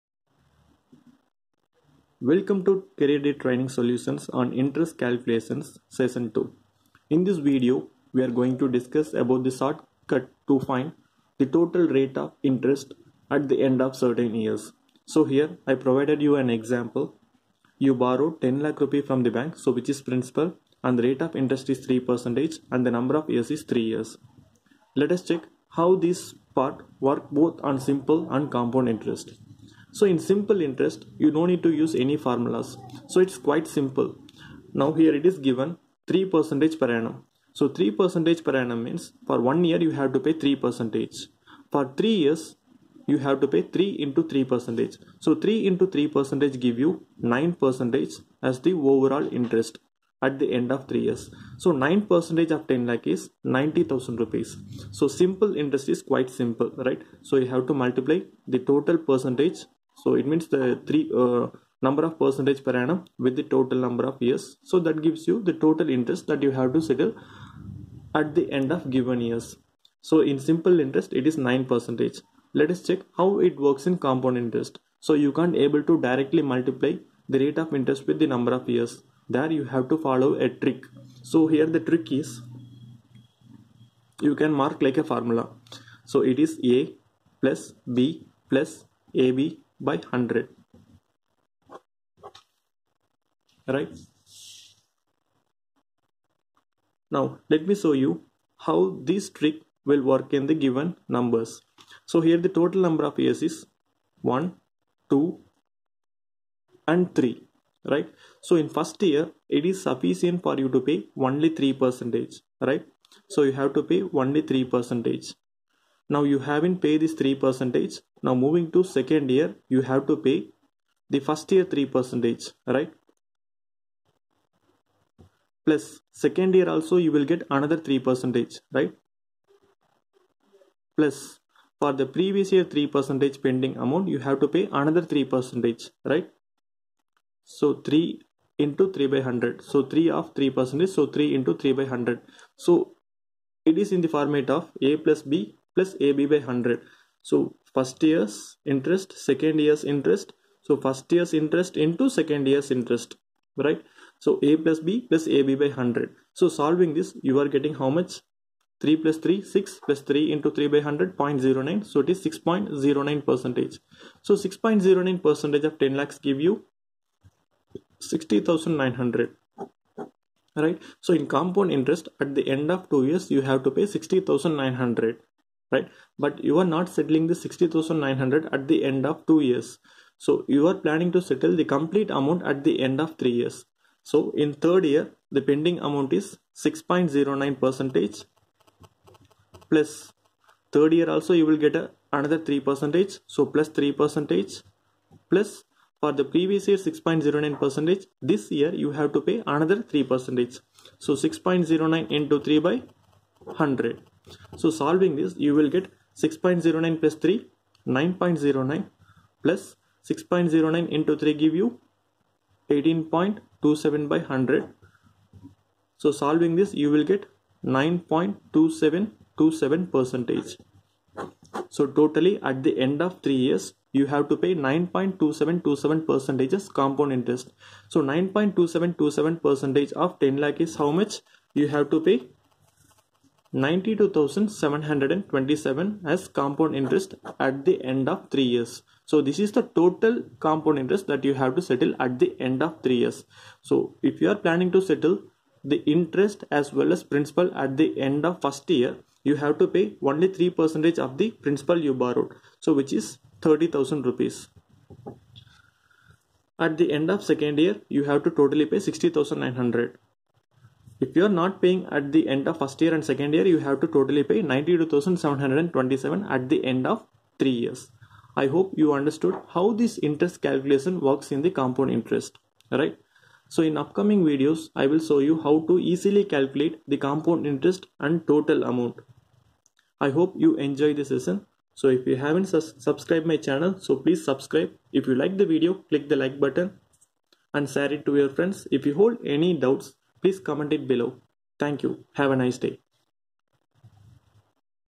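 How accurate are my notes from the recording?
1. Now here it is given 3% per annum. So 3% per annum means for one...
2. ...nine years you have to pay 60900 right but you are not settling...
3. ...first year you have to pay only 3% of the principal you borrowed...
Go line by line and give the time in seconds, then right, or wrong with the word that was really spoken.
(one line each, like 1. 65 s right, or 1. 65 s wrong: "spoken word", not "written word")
1. 34 s right
2. 172 s wrong: "two", not "nine"
3. 248 s right.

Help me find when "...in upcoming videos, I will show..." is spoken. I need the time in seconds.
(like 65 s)
273 s.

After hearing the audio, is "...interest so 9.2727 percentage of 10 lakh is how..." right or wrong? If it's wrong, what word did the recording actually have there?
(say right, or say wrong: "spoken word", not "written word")
right.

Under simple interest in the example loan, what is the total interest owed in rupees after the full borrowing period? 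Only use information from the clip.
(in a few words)
90,000.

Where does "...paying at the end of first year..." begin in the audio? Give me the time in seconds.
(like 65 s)
261 s.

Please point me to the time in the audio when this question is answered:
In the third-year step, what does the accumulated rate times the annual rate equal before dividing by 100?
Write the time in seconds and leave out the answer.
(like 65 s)
212 s.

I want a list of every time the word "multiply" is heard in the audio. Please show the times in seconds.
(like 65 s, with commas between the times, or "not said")
57 s, 76 s.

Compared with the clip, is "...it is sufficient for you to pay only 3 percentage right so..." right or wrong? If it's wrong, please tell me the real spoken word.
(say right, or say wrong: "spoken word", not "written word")
right.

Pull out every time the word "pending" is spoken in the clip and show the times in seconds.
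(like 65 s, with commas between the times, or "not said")
133 s, 185 s.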